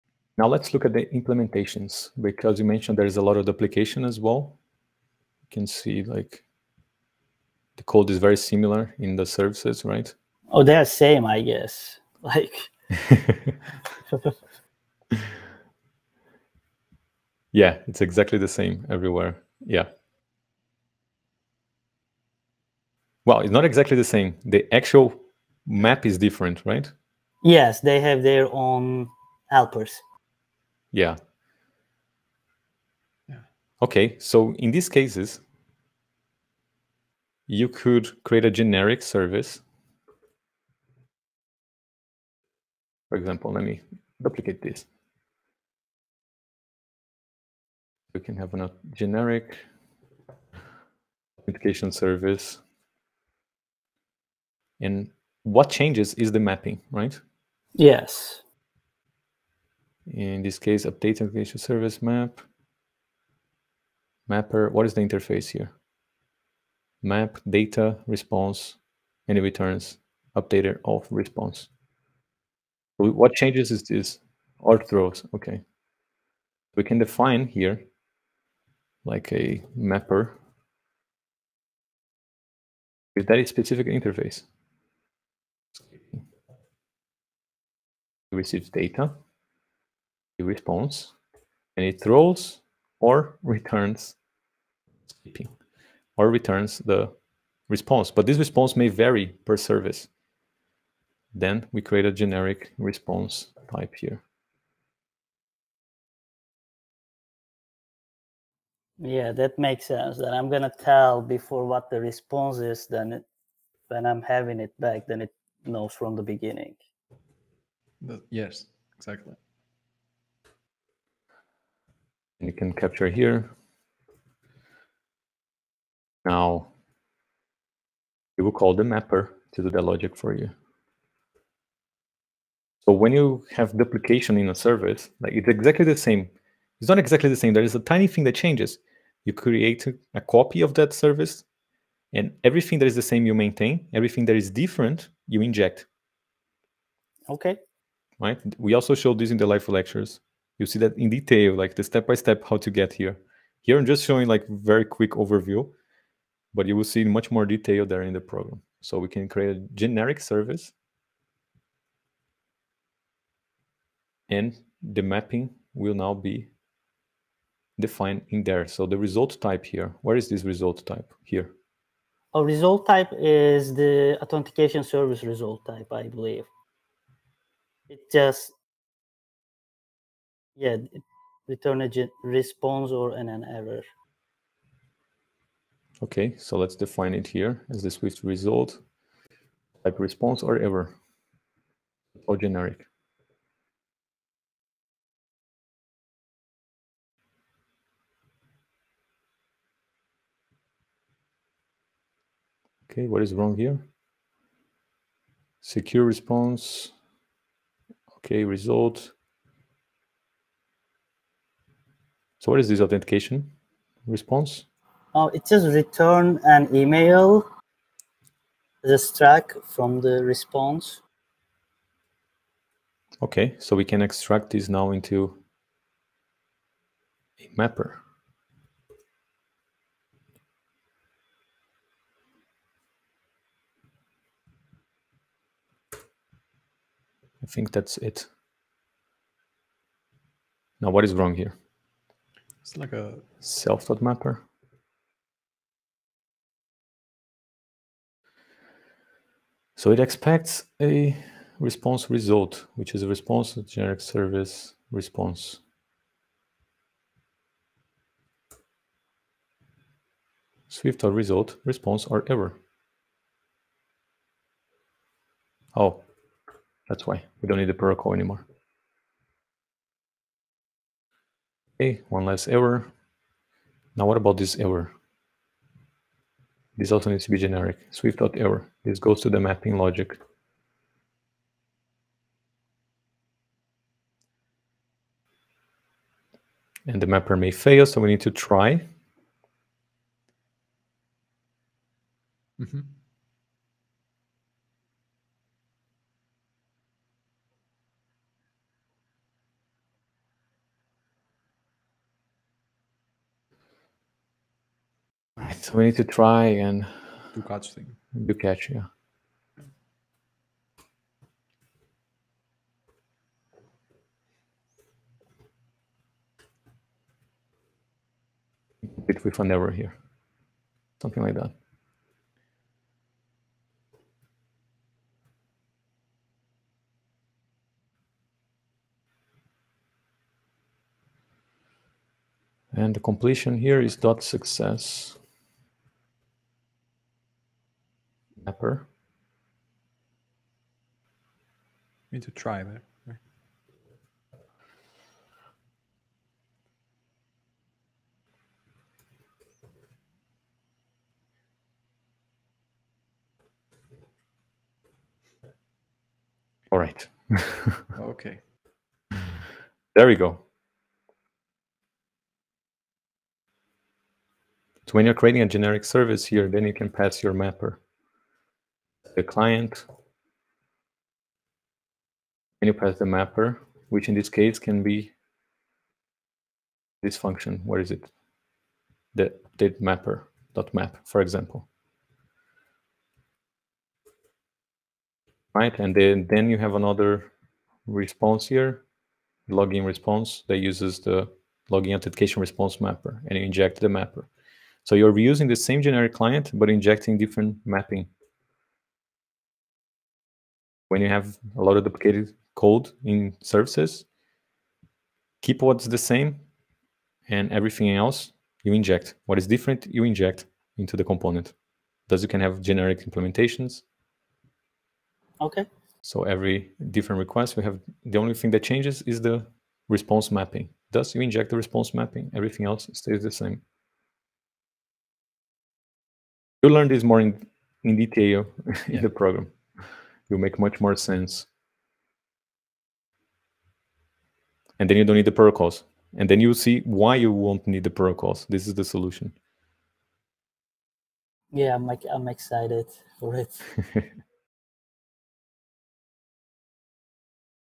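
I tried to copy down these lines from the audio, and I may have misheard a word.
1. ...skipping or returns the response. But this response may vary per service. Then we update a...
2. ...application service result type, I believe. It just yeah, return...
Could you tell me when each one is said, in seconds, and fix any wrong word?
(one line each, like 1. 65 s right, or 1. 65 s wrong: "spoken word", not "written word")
1. 95 s wrong: "create", not "update"
2. 174 s wrong: "authentication", not "application".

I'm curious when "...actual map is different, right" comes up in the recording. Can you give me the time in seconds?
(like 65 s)
24 s.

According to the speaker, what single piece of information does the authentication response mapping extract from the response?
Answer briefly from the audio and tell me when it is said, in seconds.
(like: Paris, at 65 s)
an email, at 216 s.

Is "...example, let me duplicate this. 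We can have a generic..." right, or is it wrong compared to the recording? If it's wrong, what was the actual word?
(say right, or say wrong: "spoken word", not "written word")
right.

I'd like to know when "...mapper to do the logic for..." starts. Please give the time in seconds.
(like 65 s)
128 s.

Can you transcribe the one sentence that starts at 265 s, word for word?
Oh, that's why we don't need the protocol anymore.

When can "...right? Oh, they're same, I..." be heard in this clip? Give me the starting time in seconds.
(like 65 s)
9 s.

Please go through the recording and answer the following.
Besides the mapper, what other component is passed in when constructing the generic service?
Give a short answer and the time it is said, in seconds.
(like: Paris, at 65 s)
the client, at 369 s.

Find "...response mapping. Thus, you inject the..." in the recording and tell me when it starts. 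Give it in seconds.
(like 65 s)
419 s.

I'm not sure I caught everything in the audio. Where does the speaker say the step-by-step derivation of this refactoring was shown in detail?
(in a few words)
live lectures.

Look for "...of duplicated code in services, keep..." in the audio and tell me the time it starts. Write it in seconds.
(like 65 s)
401 s.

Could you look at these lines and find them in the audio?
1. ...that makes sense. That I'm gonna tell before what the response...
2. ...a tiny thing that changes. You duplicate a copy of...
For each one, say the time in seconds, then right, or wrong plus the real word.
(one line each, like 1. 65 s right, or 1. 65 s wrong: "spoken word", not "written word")
1. 109 s right
2. 137 s wrong: "create", not "duplicate".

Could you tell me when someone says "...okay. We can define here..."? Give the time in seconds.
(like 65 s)
75 s.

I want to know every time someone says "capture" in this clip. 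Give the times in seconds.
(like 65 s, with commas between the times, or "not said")
122 s.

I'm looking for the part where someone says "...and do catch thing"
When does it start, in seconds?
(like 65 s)
306 s.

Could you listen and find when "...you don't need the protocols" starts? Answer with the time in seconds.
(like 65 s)
434 s.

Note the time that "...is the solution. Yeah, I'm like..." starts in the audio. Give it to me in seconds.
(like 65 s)
438 s.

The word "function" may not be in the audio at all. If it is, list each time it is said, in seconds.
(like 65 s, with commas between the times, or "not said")
377 s.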